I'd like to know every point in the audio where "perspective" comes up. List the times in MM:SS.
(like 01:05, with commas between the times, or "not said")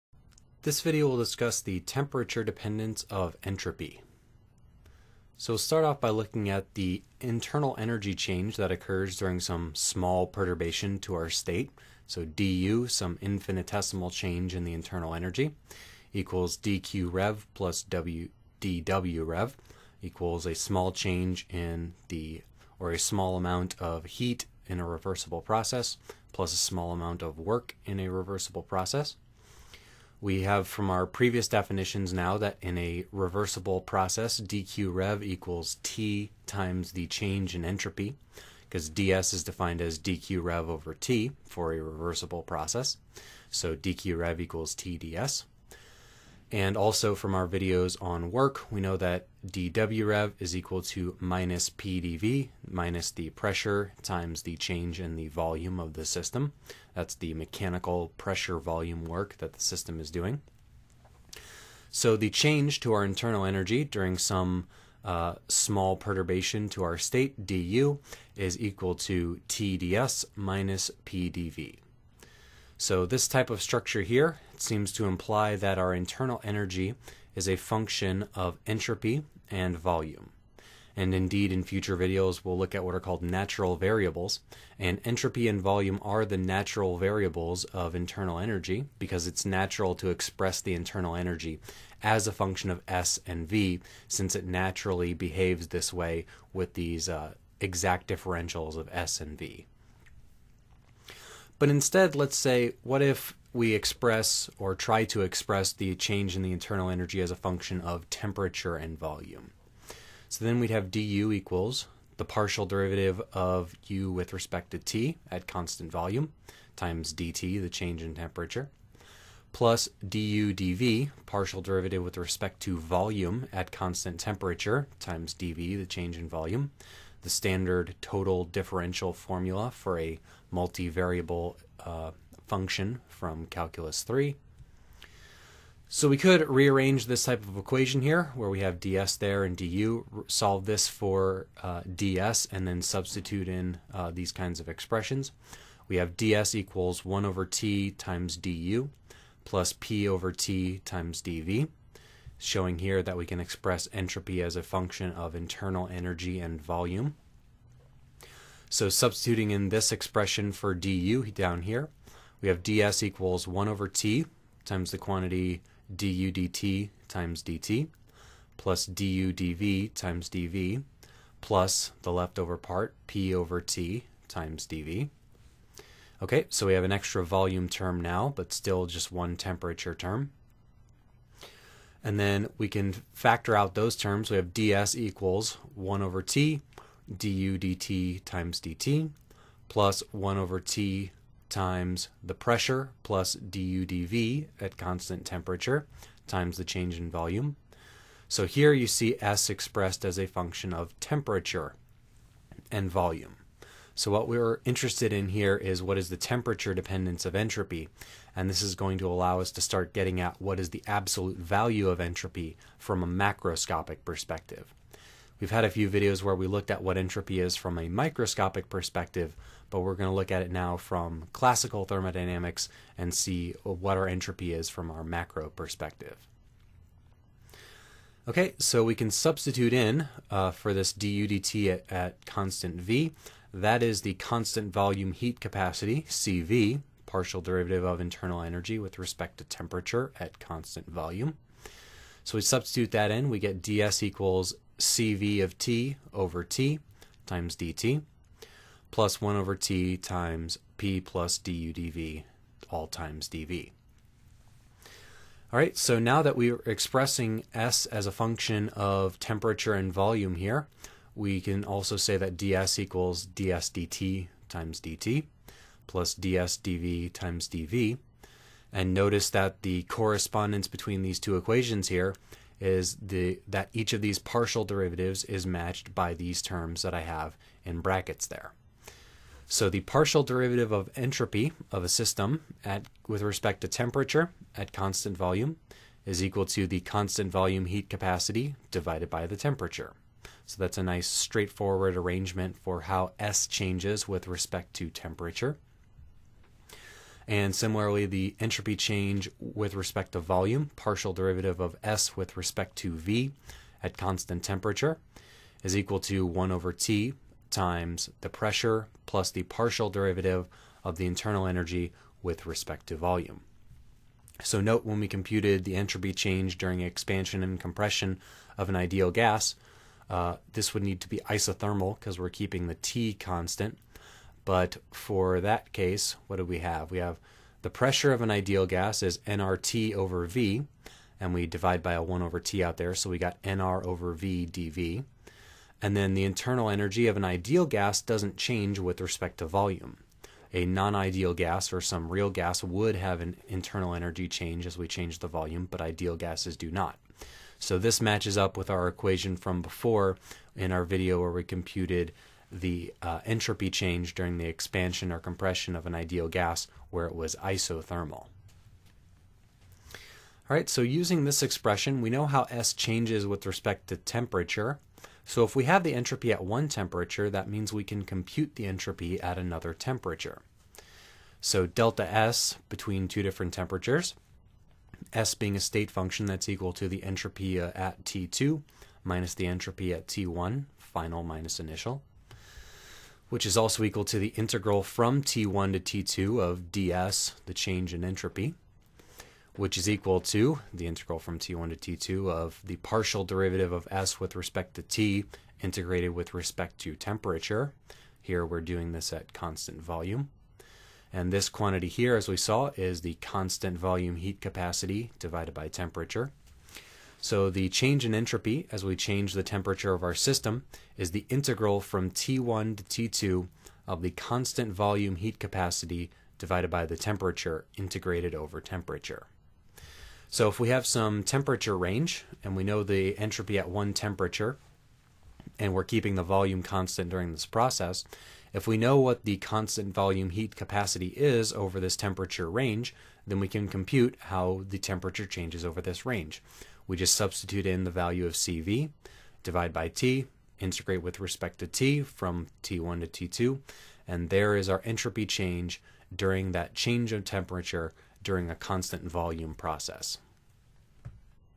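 03:34, 03:38, 03:45.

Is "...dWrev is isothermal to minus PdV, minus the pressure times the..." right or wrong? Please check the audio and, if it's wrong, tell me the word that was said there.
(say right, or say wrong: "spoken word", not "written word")
wrong: "equal", not "isothermal".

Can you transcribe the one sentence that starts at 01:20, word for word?
And indeed, in future videos, we'll look at what are called natural variables.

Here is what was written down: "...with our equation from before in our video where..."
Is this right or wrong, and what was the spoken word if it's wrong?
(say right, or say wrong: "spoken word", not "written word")
right.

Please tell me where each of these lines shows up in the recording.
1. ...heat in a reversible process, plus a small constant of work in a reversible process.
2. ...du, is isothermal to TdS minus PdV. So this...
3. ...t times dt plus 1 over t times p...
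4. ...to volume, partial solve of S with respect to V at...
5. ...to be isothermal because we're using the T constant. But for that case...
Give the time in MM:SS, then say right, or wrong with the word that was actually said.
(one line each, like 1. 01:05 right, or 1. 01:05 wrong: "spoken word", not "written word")
1. 00:24 wrong: "amount", not "constant"
2. 01:07 wrong: "equal", not "isothermal"
3. 04:06 right
4. 05:00 wrong: "derivative", not "solve"
5. 05:21 wrong: "keeping", not "using".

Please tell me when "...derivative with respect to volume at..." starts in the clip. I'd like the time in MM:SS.
02:01.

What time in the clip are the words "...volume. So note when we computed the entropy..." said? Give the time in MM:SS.
05:12.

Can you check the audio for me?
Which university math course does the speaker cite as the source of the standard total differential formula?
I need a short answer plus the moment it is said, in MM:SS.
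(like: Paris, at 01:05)
Calculus 3, at 02:13.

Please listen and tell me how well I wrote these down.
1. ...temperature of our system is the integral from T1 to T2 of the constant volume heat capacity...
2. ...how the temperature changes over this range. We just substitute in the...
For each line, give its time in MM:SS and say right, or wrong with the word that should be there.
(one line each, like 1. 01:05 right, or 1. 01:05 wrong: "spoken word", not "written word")
1. 06:49 right
2. 07:14 right.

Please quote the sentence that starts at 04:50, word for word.
So that's a nice straightforward arrangement for how S changes with respect to temperature.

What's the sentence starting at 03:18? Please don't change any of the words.
So here you see S expressed as a function of temperature and volume.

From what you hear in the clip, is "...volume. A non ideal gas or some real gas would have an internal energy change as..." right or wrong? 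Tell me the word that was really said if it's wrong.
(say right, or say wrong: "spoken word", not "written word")
right.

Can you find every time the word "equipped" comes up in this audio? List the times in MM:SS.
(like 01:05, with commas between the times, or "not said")
not said.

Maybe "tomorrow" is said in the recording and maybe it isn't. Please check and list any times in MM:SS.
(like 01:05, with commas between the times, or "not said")
not said.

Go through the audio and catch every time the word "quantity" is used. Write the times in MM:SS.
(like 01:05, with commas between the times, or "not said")
02:44, 06:41.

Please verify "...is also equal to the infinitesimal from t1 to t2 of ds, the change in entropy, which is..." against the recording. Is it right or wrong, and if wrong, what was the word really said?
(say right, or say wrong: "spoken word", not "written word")
wrong: "integral", not "infinitesimal".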